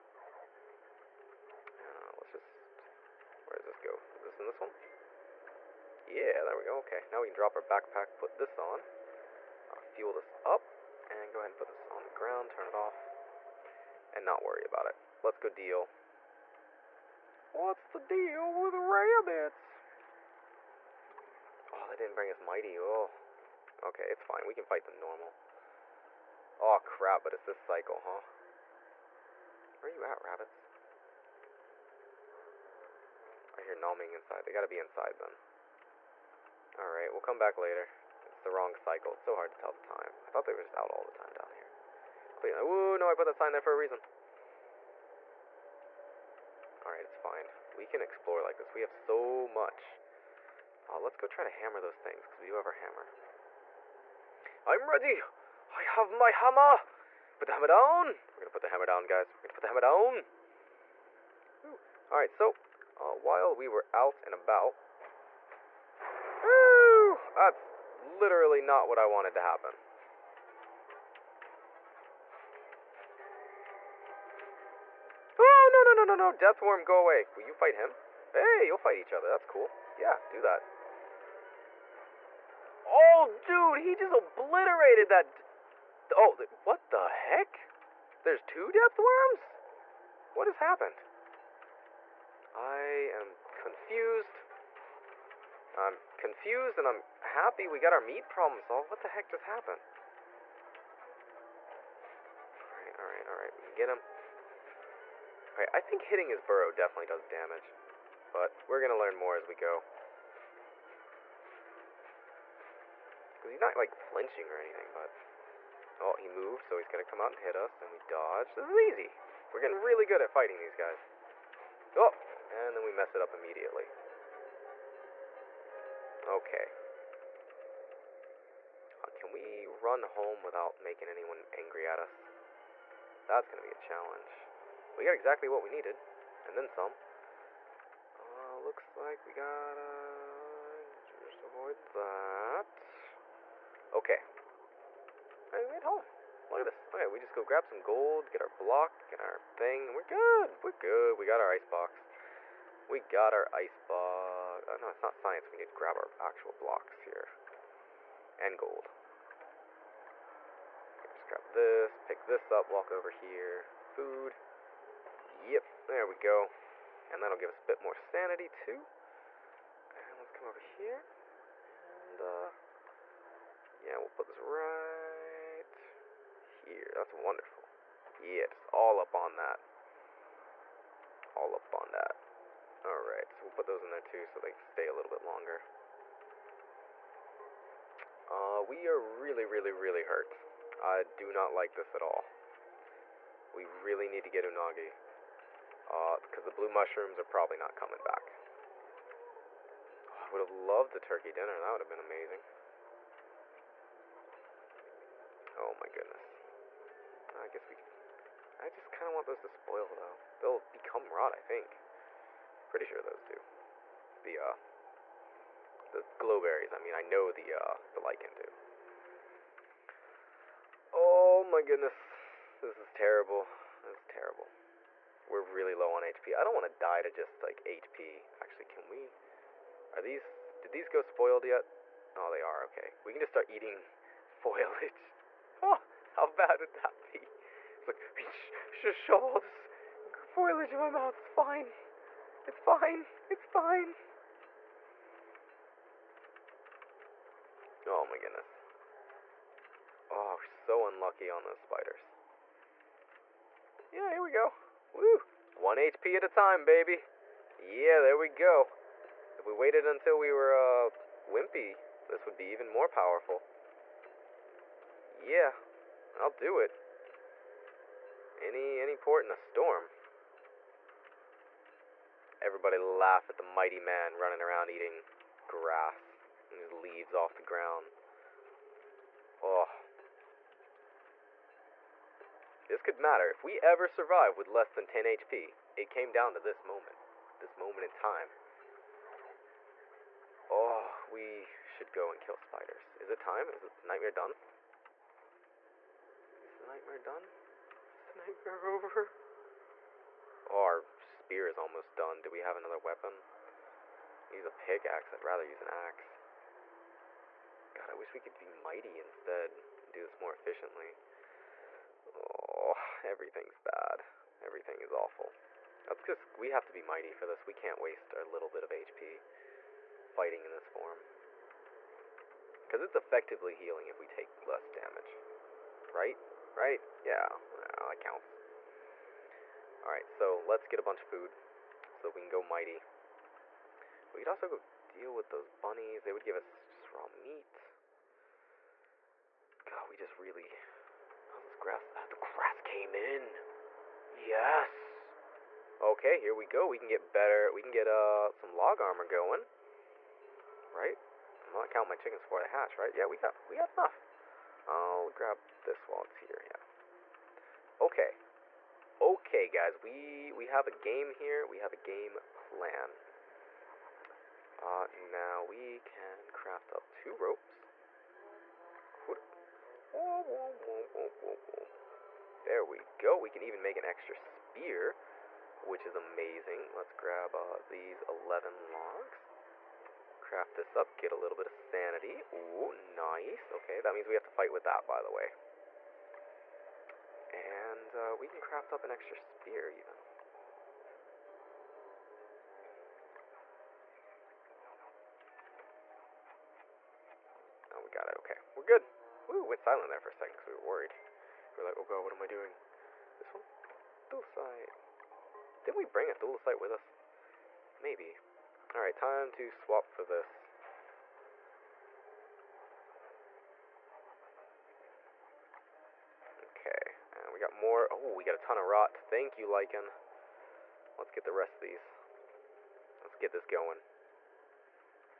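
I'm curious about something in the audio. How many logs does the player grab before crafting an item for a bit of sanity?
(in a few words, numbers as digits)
11.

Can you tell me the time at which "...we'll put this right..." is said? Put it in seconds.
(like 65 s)
173 s.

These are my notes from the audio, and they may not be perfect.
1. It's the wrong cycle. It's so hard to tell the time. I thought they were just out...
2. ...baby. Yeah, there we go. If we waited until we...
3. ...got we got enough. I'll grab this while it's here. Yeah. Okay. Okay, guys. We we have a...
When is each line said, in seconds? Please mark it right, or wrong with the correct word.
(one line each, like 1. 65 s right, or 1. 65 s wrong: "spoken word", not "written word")
1. 38 s right
2. 256 s right
3. 353 s right.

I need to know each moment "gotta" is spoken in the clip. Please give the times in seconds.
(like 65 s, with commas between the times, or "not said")
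34 s, 139 s.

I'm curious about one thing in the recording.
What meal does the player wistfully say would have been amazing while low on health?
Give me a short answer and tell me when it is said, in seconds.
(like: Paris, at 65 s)
Turkey dinner, at 200 s.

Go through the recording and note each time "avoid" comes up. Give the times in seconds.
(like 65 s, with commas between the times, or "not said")
141 s.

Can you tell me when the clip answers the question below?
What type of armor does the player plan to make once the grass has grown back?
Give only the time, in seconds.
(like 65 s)
348 s.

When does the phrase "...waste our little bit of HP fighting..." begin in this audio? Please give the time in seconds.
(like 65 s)
317 s.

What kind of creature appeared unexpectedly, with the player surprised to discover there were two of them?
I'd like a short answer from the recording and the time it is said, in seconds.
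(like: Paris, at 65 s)
Depth worms, at 88 s.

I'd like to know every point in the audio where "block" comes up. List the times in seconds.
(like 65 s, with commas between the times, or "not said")
148 s, 156 s.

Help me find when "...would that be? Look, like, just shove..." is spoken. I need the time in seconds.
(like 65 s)
236 s.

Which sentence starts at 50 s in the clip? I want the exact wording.
Uh, let's go try to hammer those things, because we do have our hammer.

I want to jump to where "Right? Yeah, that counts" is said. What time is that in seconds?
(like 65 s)
326 s.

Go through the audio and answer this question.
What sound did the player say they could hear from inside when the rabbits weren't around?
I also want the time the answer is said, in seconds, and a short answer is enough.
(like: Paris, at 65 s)
Numbing, at 33 s.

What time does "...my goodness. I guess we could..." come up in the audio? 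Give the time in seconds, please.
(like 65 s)
205 s.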